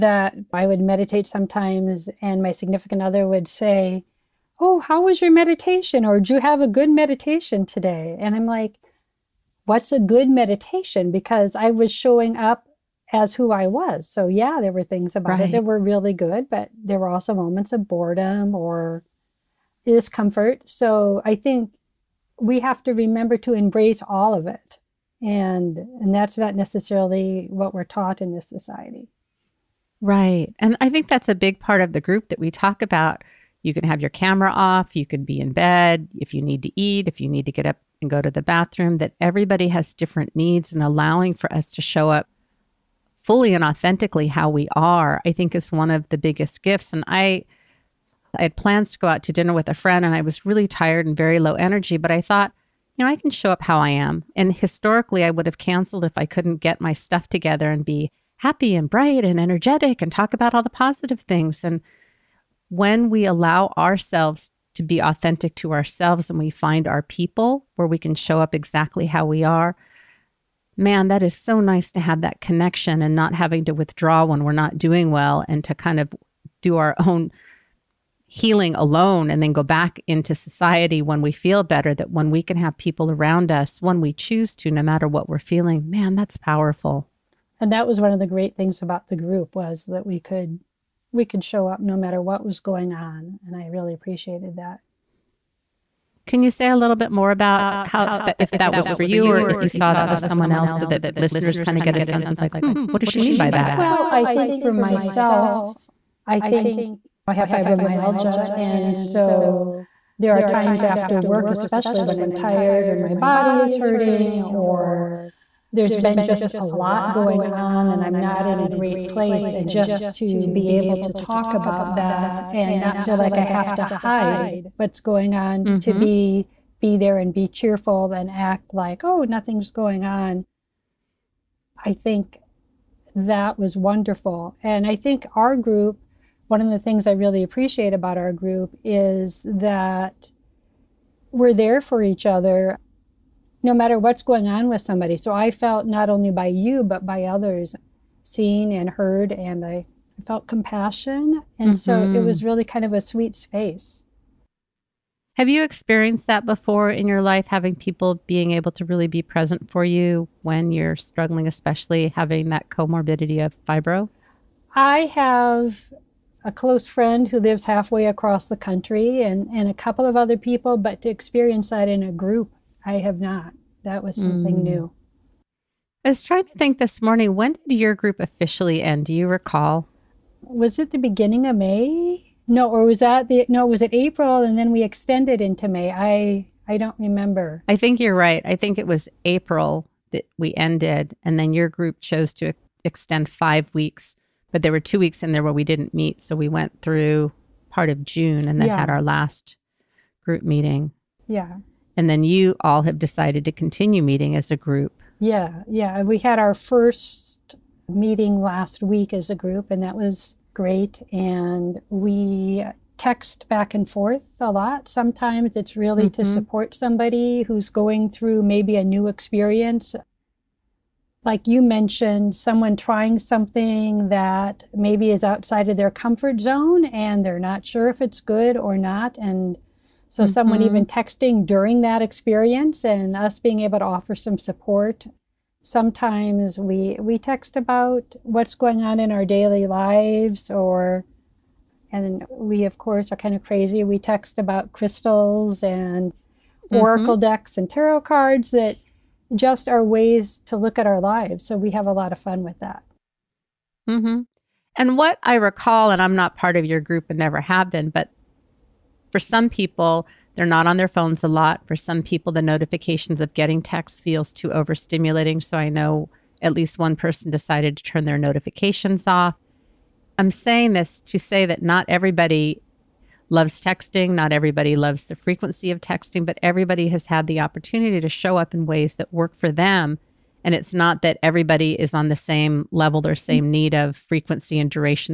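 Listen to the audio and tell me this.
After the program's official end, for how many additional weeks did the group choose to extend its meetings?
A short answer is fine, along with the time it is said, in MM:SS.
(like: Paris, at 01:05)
5, at 03:13.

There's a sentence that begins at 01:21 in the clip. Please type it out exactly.
That when we can have people around us when we choose to, no matter what we're feeling, man, that's powerful.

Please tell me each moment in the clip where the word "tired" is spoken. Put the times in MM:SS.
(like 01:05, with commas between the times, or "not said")
00:50, 01:52.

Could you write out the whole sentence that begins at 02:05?
to be be there and be cheerful and act like, oh, nothing's going on.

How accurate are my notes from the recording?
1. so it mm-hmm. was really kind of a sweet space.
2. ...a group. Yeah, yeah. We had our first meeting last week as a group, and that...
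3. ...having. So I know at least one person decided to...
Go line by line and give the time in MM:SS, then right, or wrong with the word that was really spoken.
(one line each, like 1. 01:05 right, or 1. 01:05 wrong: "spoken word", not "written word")
1. 02:31 right
2. 03:24 right
3. 04:24 wrong: "overstimulating", not "having".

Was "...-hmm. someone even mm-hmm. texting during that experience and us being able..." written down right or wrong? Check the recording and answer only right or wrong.
right.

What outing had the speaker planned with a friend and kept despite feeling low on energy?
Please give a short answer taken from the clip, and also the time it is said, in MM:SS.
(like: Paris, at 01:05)
dinner, at 00:49.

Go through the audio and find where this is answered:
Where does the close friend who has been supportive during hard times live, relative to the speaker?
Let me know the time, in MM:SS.
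02:47.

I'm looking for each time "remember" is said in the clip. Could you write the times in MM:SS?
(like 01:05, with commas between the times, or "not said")
00:22, 03:06.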